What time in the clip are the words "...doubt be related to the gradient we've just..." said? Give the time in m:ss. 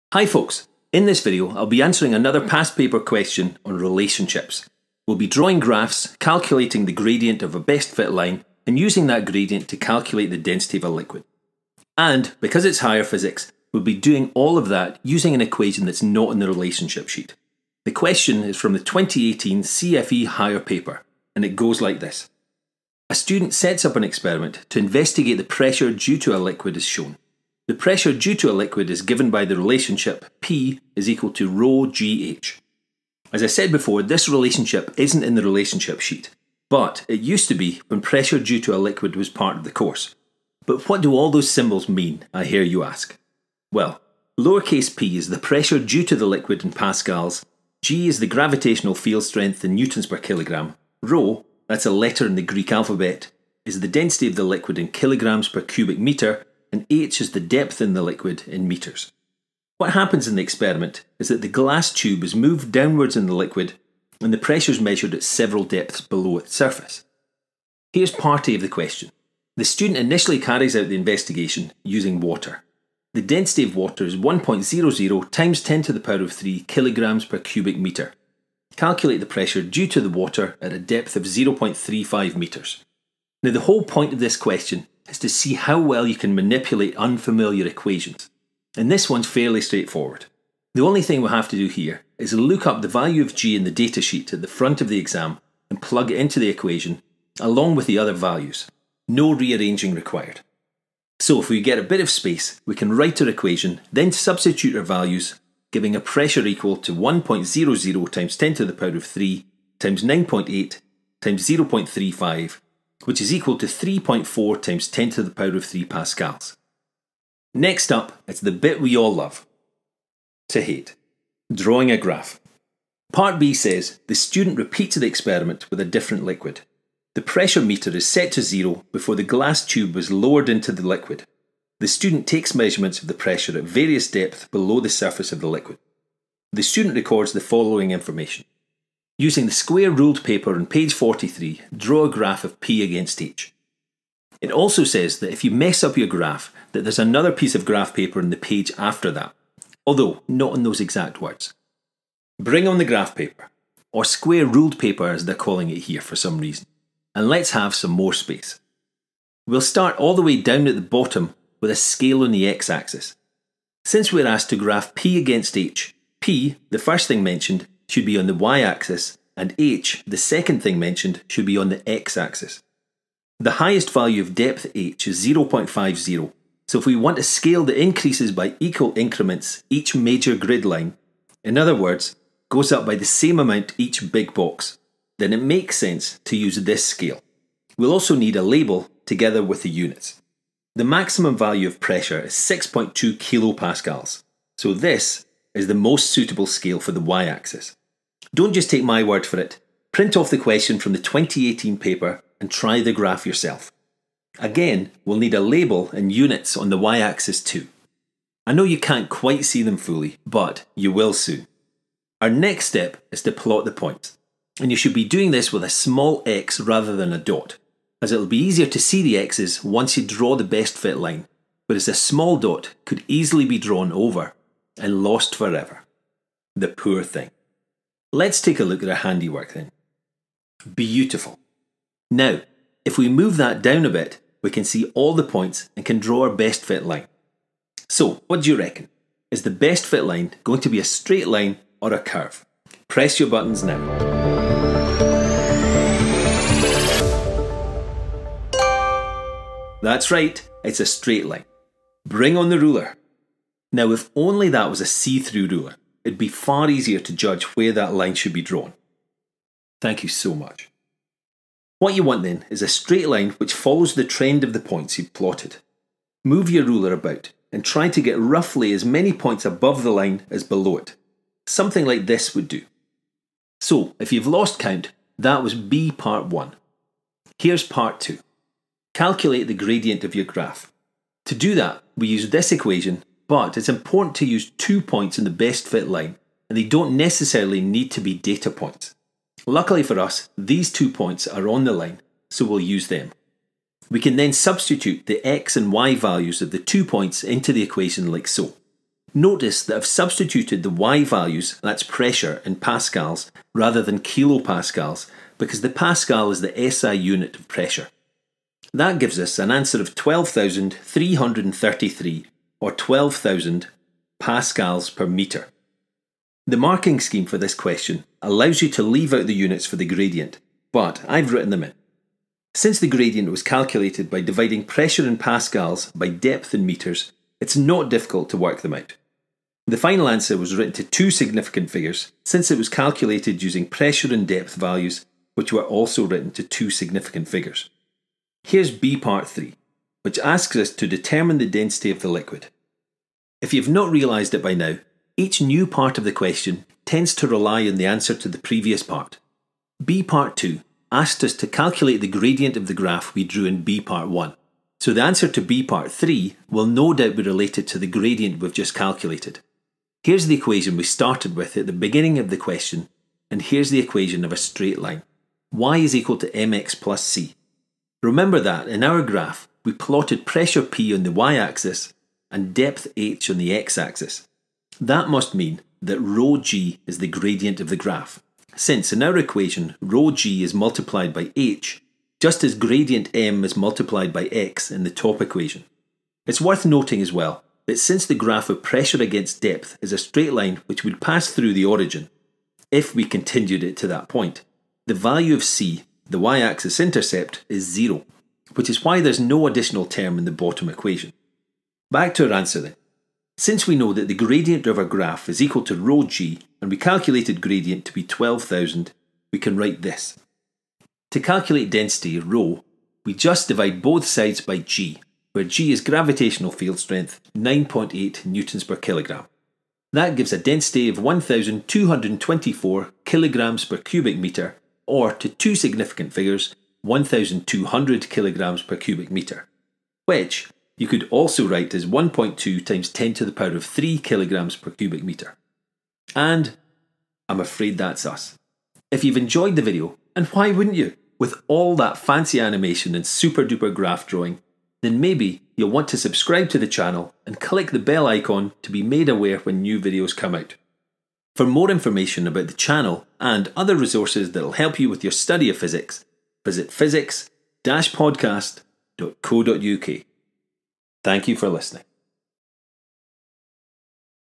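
5:56.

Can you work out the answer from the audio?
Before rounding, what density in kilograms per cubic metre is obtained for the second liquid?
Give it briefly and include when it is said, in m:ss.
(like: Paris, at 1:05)
1,224, at 7:00.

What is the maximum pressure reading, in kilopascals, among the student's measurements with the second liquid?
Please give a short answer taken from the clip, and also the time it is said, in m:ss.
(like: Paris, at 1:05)
6.2, at 3:12.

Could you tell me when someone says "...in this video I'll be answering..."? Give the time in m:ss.
0:00.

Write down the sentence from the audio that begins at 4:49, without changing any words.
Luckily for us, these two points are on the line, so we'll use them.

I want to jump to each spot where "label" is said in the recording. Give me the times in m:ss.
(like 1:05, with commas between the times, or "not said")
3:08, 3:25.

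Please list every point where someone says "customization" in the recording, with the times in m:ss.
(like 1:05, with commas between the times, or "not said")
not said.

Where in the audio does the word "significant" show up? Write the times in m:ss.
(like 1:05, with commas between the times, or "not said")
5:31, 5:36, 7:05.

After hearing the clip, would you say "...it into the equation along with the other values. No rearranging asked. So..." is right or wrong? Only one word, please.
wrong.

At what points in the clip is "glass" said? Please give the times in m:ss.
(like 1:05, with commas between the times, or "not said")
1:01, 2:09.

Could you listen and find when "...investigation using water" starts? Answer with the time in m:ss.
1:10.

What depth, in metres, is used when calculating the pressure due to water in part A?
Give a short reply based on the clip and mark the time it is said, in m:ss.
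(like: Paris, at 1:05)
0.35 metres, at 1:21.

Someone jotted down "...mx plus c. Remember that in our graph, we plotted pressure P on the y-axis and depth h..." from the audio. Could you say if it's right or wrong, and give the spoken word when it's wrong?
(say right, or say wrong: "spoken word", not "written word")
right.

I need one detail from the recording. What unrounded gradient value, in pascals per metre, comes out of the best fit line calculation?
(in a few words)
12,333.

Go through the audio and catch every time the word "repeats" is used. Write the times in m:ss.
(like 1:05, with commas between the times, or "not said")
2:04.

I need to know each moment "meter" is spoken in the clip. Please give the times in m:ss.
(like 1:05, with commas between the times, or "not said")
2:07, 7:09, 7:15.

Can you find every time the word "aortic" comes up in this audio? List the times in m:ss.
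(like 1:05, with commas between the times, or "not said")
not said.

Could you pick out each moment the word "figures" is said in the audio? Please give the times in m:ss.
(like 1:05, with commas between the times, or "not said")
5:31, 5:37, 7:06.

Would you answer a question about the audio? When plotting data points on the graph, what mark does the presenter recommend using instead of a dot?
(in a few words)
a small x.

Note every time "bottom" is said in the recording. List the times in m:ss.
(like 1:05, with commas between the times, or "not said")
2:40, 6:40.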